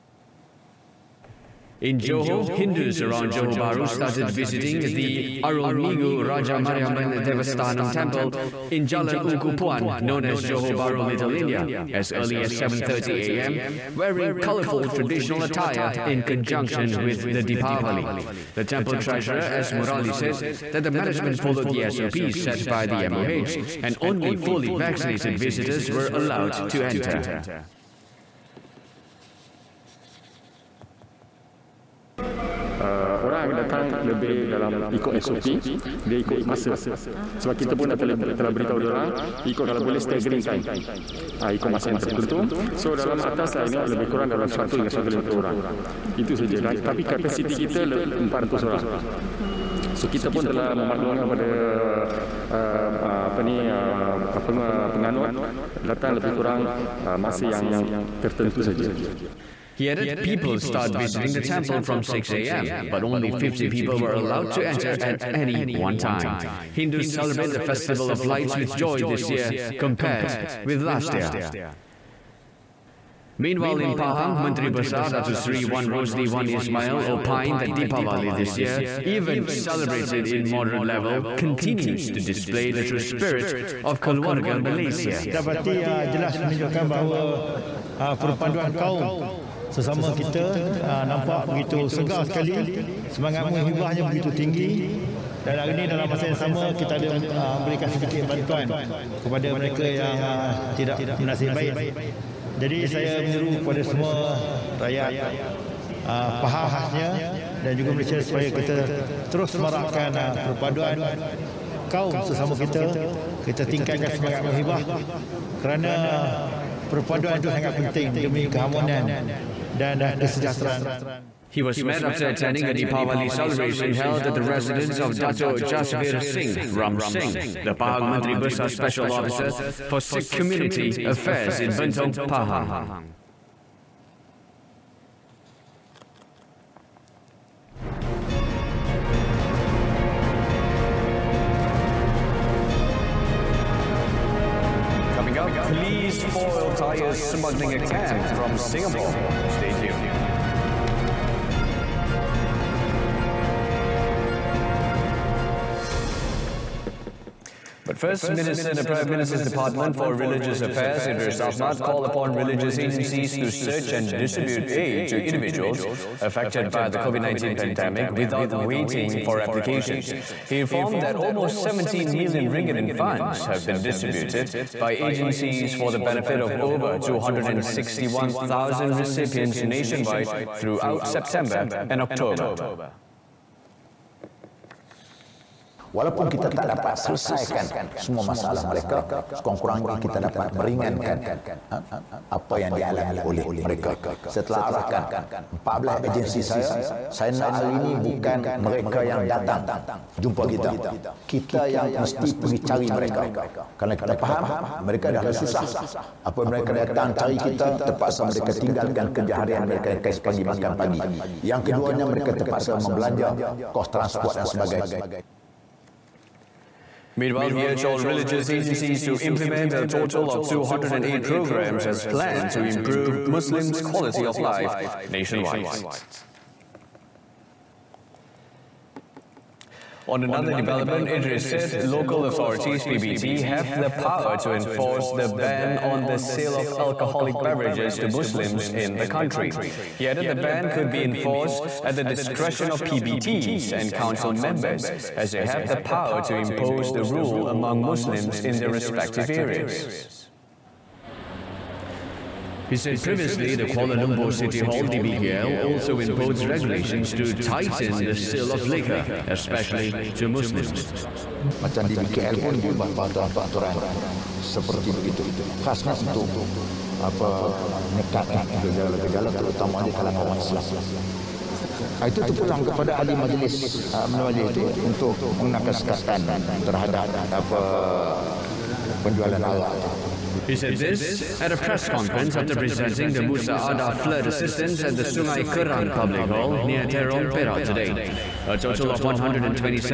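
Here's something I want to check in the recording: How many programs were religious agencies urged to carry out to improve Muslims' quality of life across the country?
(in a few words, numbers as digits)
208.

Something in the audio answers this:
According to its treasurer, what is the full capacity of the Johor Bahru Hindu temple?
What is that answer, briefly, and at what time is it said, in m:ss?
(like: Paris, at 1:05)
400 people, at 0:47.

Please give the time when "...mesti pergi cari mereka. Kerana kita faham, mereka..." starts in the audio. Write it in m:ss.
3:21.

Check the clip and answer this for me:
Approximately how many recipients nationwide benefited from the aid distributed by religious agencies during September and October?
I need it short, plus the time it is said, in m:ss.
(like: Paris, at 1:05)
261,000, at 2:56.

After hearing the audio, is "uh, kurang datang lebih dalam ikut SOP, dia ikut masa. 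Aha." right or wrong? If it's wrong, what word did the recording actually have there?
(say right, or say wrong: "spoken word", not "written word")
wrong: "orang", not "kurang".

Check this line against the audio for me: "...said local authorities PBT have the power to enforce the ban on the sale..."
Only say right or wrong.
right.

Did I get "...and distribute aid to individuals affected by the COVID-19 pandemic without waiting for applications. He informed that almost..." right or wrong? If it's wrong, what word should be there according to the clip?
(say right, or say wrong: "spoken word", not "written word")
right.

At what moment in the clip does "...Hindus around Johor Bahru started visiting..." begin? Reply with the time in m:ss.
0:02.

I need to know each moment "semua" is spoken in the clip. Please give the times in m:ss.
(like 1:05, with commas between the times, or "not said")
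1:43, 3:07.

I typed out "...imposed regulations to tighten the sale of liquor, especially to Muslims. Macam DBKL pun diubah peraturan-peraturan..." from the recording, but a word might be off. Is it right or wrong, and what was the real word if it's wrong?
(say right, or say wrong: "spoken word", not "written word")
right.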